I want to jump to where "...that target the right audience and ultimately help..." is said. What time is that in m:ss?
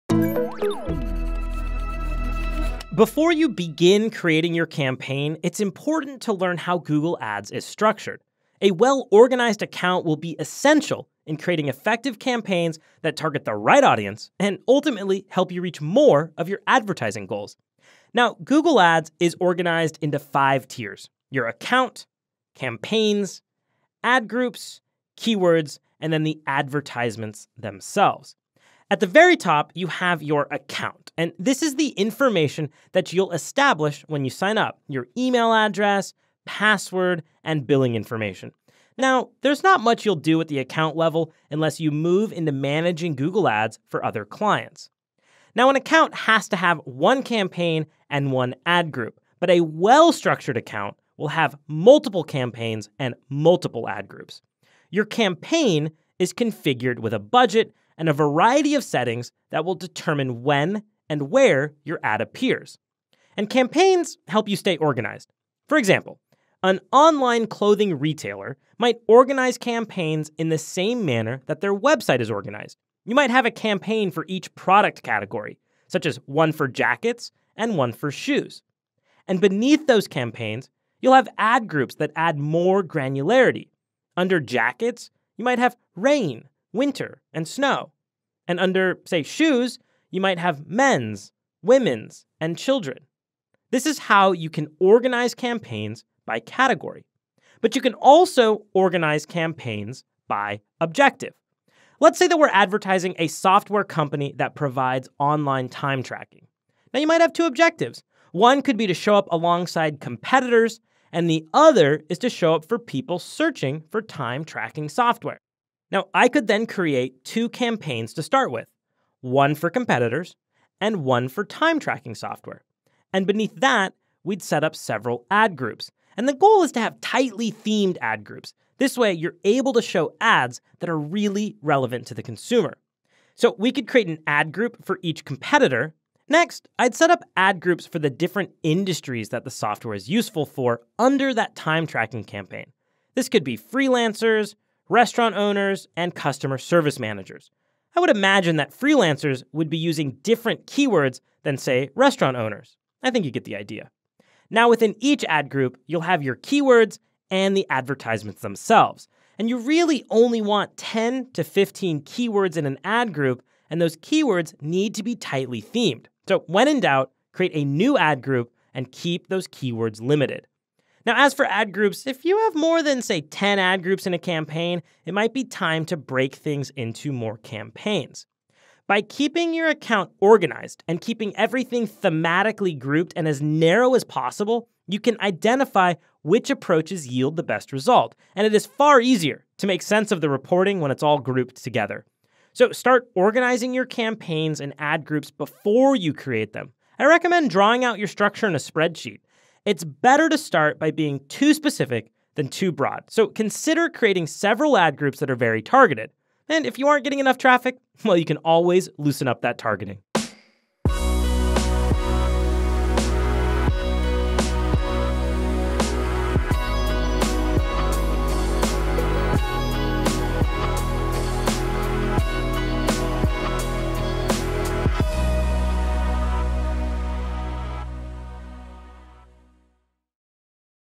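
0:13.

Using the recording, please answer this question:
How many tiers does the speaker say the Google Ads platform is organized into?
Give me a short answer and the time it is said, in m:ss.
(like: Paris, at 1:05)
5, at 0:20.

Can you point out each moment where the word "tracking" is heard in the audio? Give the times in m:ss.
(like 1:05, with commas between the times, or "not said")
1:46, 1:54, 2:01, 2:21.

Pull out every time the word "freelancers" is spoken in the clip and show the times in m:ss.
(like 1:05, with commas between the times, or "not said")
2:23, 2:28.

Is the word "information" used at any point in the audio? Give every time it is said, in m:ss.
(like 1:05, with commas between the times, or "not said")
0:31, 0:37.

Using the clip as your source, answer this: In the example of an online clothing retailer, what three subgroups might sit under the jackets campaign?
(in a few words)
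rain, winter, and snow.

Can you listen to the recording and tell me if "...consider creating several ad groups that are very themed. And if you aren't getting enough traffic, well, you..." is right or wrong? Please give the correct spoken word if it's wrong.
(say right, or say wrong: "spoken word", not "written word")
wrong: "targeted", not "themed".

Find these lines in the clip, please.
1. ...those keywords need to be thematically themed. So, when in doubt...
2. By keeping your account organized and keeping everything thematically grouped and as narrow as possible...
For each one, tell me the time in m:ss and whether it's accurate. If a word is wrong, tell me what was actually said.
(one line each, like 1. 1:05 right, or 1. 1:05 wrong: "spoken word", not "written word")
1. 2:43 wrong: "tightly", not "thematically"
2. 2:58 right.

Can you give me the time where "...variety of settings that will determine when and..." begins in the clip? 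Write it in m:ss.
0:58.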